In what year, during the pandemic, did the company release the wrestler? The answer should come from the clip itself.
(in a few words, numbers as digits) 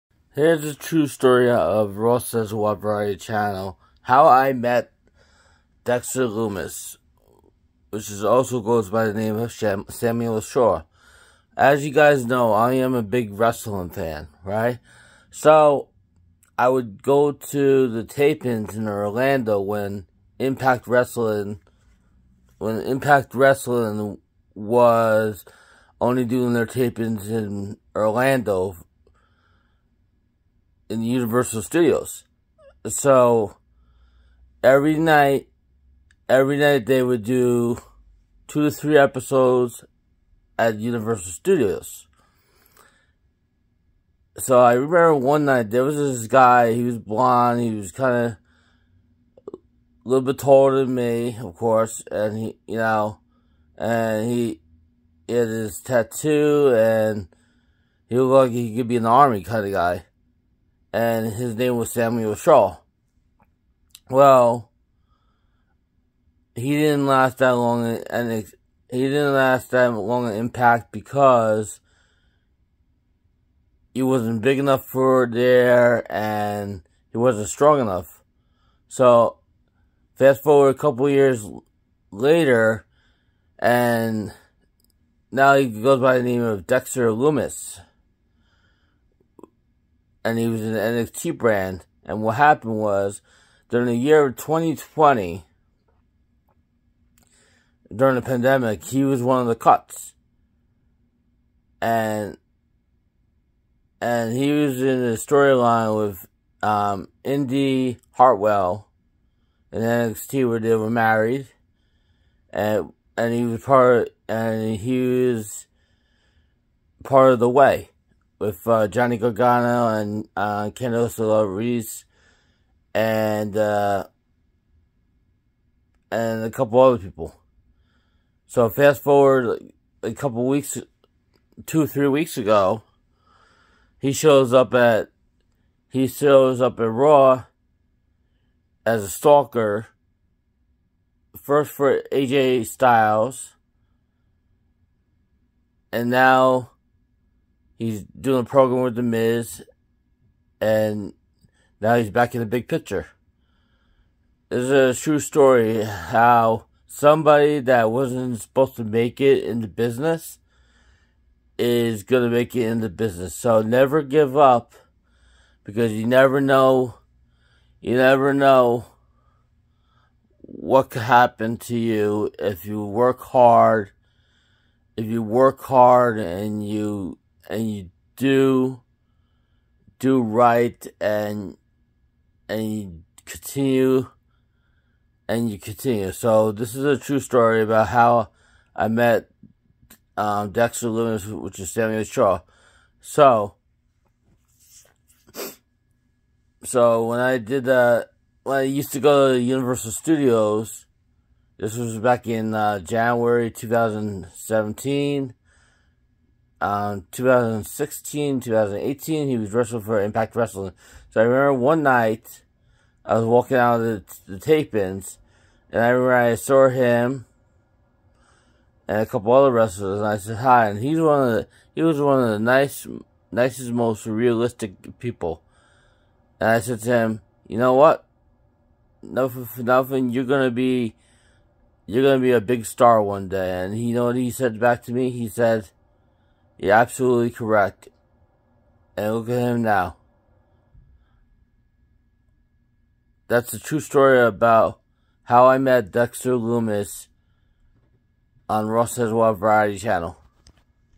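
2020.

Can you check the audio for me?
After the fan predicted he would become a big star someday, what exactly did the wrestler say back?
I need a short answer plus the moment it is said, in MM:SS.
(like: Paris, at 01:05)
You're absolutely correct, at 03:56.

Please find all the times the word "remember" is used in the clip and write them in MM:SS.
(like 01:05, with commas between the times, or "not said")
00:44, 03:31, 03:35.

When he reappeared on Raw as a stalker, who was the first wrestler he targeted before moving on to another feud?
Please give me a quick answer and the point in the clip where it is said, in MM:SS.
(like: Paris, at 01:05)
AJ Styles, at 02:22.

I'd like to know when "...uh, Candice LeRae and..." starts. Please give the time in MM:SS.
02:00.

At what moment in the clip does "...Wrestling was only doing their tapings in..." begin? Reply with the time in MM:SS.
00:23.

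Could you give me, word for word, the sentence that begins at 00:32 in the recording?
So every night, every night they would do two to three episodes at Universal Studios.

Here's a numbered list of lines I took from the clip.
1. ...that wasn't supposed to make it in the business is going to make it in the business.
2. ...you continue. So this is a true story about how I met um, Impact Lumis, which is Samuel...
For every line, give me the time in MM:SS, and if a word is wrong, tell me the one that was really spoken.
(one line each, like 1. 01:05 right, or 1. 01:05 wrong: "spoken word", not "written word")
1. 02:37 right
2. 03:05 wrong: "Dexter", not "Impact".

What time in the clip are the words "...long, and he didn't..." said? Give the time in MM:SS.
01:07.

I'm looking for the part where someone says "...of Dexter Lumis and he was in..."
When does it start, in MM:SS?
01:26.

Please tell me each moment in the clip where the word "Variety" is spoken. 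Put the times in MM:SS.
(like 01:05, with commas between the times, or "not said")
00:02, 04:09.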